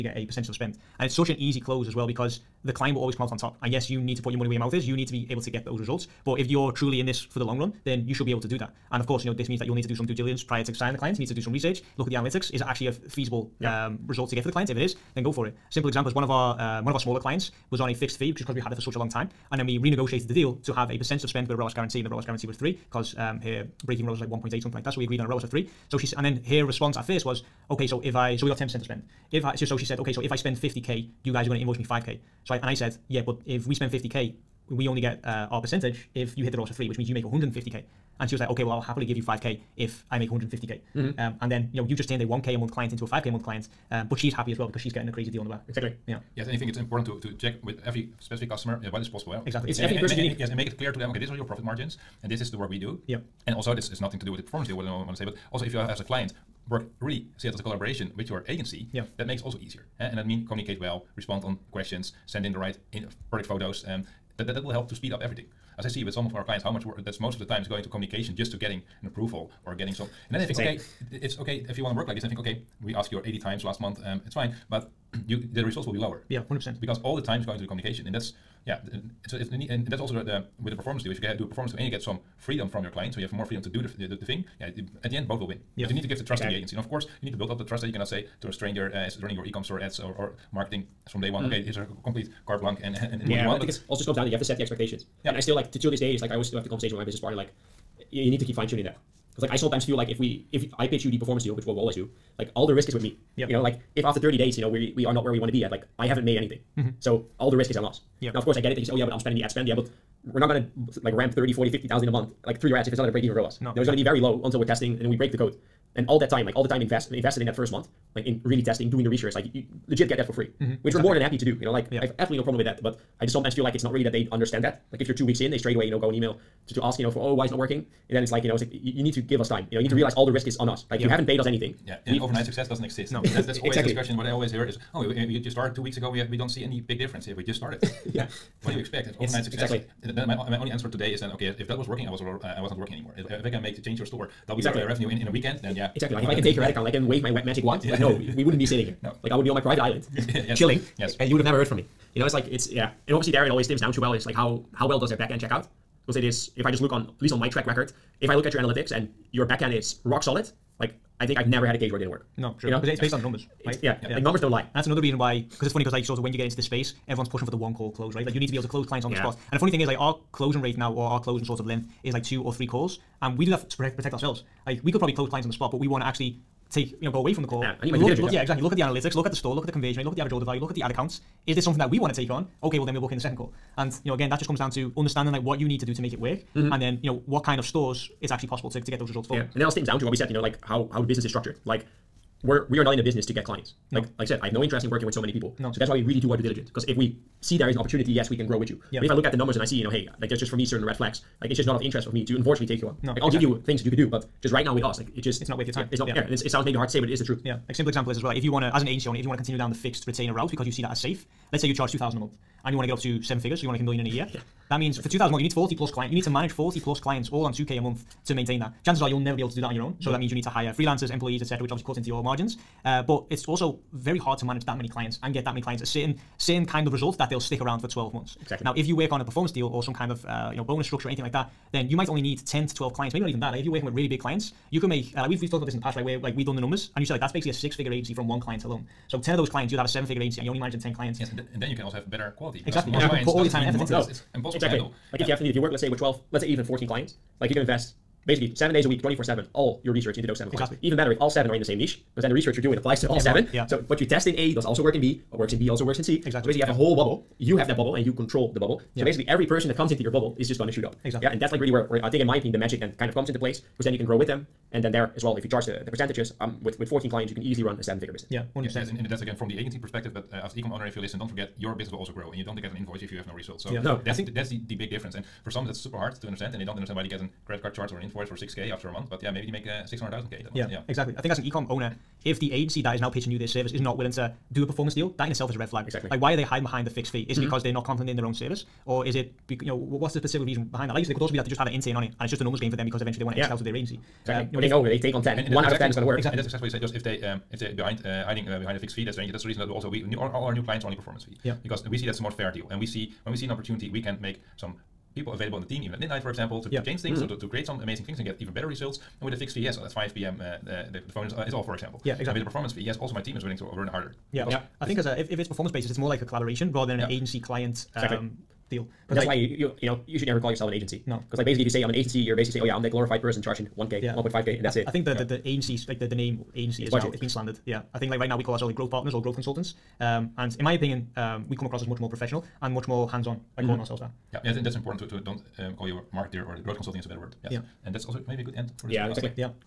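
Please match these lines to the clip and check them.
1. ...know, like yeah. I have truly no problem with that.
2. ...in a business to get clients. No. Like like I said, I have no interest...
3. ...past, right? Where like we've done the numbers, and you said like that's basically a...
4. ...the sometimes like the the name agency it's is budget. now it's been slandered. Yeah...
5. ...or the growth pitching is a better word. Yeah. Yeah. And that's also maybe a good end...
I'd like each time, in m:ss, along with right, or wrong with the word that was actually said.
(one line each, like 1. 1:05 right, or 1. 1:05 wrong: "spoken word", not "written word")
1. 2:01 wrong: "absolutely", not "truly"
2. 3:12 right
3. 3:55 right
4. 5:25 wrong: "agencies", not "sometimes"
5. 5:36 wrong: "consulting", not "pitching".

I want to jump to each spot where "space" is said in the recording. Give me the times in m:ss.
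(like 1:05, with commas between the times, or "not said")
2:46.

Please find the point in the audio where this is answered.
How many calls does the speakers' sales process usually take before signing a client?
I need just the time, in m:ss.
2:52.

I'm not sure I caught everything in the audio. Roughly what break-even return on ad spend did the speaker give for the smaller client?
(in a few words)
1.8.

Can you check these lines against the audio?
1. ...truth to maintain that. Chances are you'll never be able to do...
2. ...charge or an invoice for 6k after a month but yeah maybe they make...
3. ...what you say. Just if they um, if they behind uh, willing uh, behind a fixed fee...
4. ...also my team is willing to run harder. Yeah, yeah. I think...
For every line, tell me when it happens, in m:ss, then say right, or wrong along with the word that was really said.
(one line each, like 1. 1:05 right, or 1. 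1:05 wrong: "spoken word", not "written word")
1. 3:37 wrong: "month", not "truth"
2. 4:37 right
3. 4:56 wrong: "hiding", not "willing"
4. 5:12 right.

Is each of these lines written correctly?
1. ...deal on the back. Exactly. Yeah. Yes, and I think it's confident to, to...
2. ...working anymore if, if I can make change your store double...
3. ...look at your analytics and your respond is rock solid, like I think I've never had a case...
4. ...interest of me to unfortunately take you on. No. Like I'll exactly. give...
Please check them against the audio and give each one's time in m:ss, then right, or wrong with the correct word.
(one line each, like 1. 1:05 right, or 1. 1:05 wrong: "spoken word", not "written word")
1. 0:45 wrong: "important", not "confident"
2. 2:22 right
3. 2:38 wrong: "backend", not "respond"
4. 3:21 right.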